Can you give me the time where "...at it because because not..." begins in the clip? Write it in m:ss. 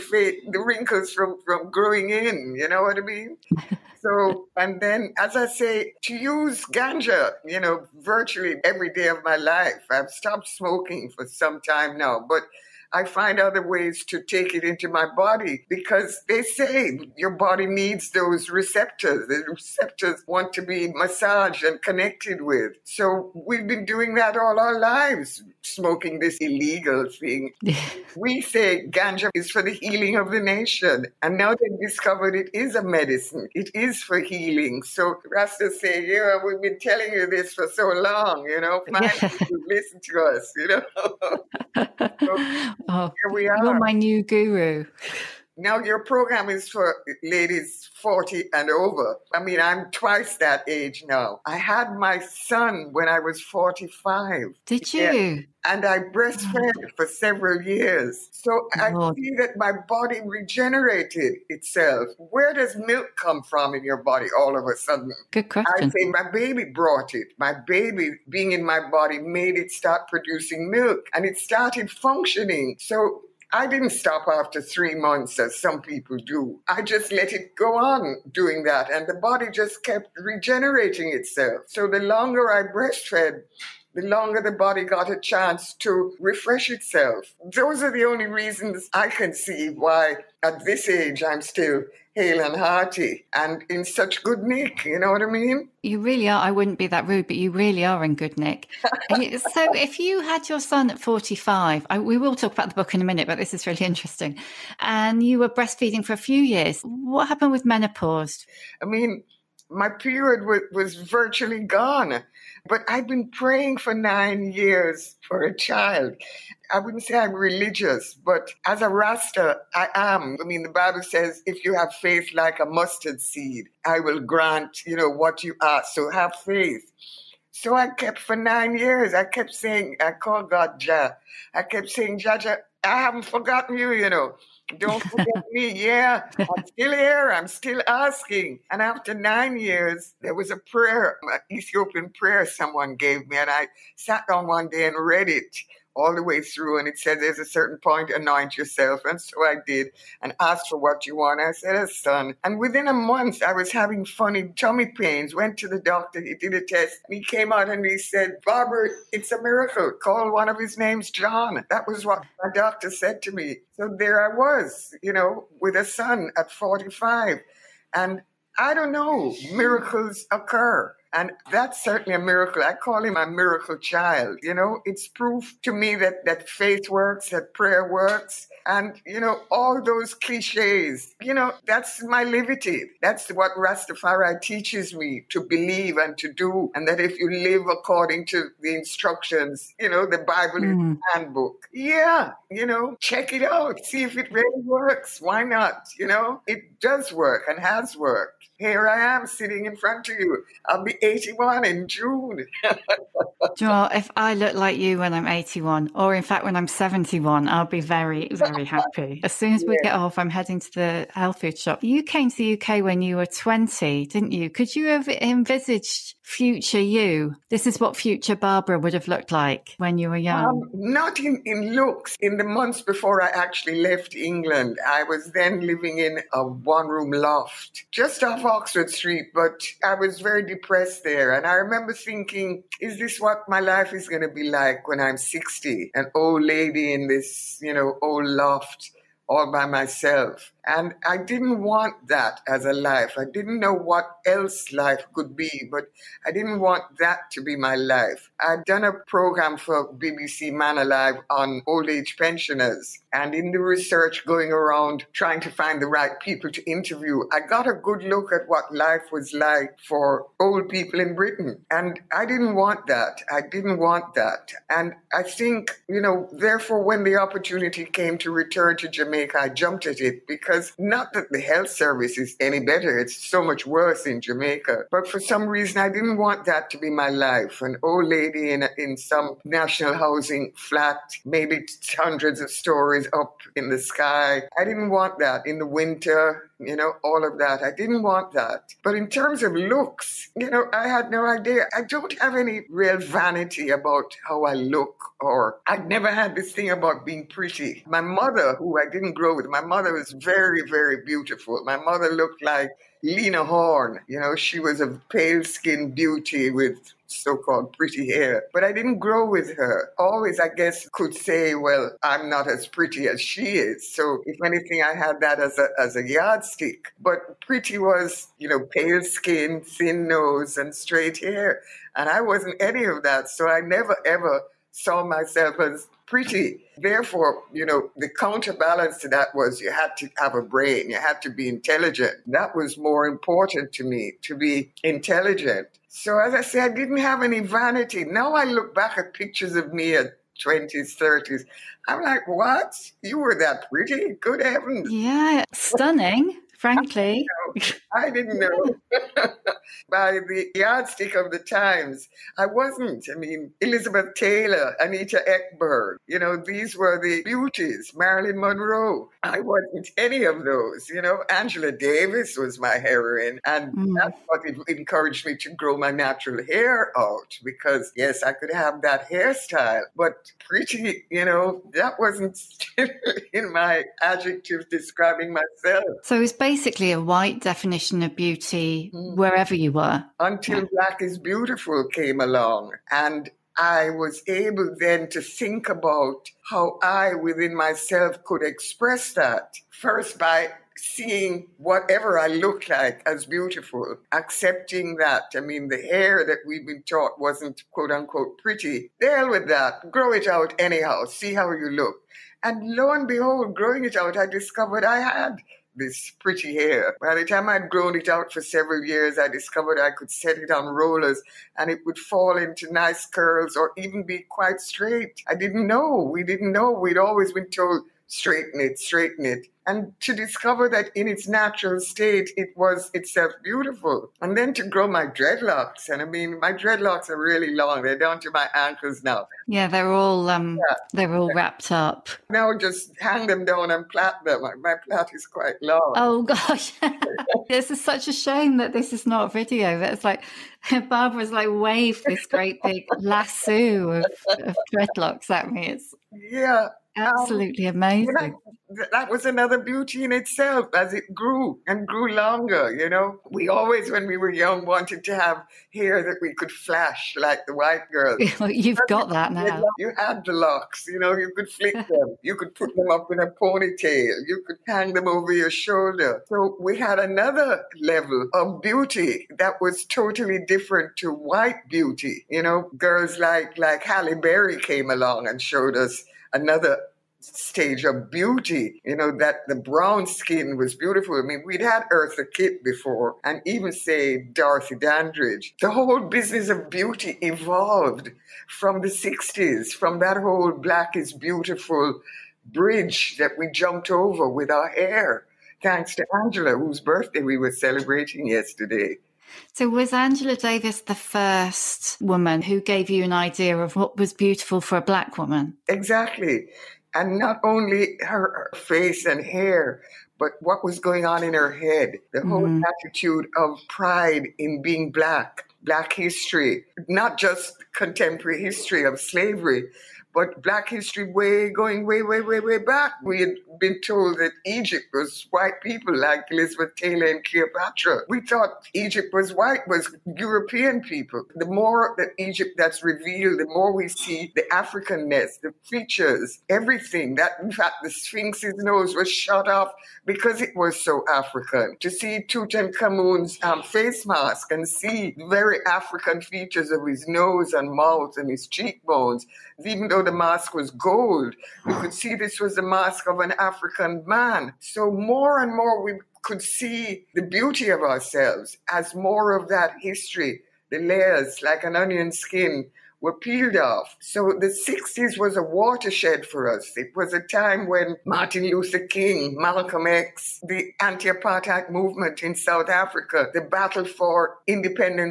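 4:29.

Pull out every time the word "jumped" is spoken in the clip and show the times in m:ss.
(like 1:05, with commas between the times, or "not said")
4:29, 8:13.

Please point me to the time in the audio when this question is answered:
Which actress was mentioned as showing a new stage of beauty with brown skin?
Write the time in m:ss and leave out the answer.
7:53.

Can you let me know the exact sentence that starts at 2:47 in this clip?
And I don't know, miracles occur.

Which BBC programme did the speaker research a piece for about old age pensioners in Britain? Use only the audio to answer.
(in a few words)
Man Alive.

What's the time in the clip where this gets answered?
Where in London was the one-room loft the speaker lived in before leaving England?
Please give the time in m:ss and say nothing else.
3:47.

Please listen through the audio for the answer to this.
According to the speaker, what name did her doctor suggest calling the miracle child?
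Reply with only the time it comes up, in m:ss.
2:41.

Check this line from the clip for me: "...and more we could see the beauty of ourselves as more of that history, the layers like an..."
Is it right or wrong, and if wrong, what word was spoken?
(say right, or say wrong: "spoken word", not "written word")
right.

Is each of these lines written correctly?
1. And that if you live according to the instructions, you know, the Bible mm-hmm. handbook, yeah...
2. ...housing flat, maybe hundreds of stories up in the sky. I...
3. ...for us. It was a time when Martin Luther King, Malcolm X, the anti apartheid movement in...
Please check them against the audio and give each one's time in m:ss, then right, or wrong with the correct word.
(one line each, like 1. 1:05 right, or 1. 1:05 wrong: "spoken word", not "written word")
1. 3:06 right
2. 4:39 right
3. 9:26 right.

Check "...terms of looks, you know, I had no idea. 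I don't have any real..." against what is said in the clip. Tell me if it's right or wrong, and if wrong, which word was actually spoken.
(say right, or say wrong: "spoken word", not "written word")
right.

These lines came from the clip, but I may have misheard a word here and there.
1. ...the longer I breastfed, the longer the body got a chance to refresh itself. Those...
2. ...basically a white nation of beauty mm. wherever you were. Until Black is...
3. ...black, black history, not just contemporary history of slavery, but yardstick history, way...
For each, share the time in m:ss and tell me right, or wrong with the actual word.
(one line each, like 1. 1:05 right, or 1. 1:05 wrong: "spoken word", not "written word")
1. 1:21 right
2. 6:16 wrong: "definition", not "nation"
3. 8:34 wrong: "black", not "yardstick".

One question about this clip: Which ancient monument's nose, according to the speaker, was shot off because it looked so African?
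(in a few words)
the Sphinx.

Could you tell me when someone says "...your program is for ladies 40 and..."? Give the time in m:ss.
0:45.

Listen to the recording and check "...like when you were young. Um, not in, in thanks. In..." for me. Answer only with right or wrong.
wrong.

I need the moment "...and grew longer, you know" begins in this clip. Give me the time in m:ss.
7:31.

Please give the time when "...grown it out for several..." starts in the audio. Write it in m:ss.
6:47.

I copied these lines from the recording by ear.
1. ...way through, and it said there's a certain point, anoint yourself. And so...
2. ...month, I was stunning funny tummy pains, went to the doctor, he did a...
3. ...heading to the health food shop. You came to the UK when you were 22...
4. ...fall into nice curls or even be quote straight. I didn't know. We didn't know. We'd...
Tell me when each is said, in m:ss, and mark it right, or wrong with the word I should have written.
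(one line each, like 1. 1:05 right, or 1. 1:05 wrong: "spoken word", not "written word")
1. 2:26 right
2. 2:32 wrong: "having", not "stunning"
3. 3:30 wrong: "20", not "22"
4. 6:51 wrong: "quite", not "quote".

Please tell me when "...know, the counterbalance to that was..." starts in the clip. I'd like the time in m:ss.
5:27.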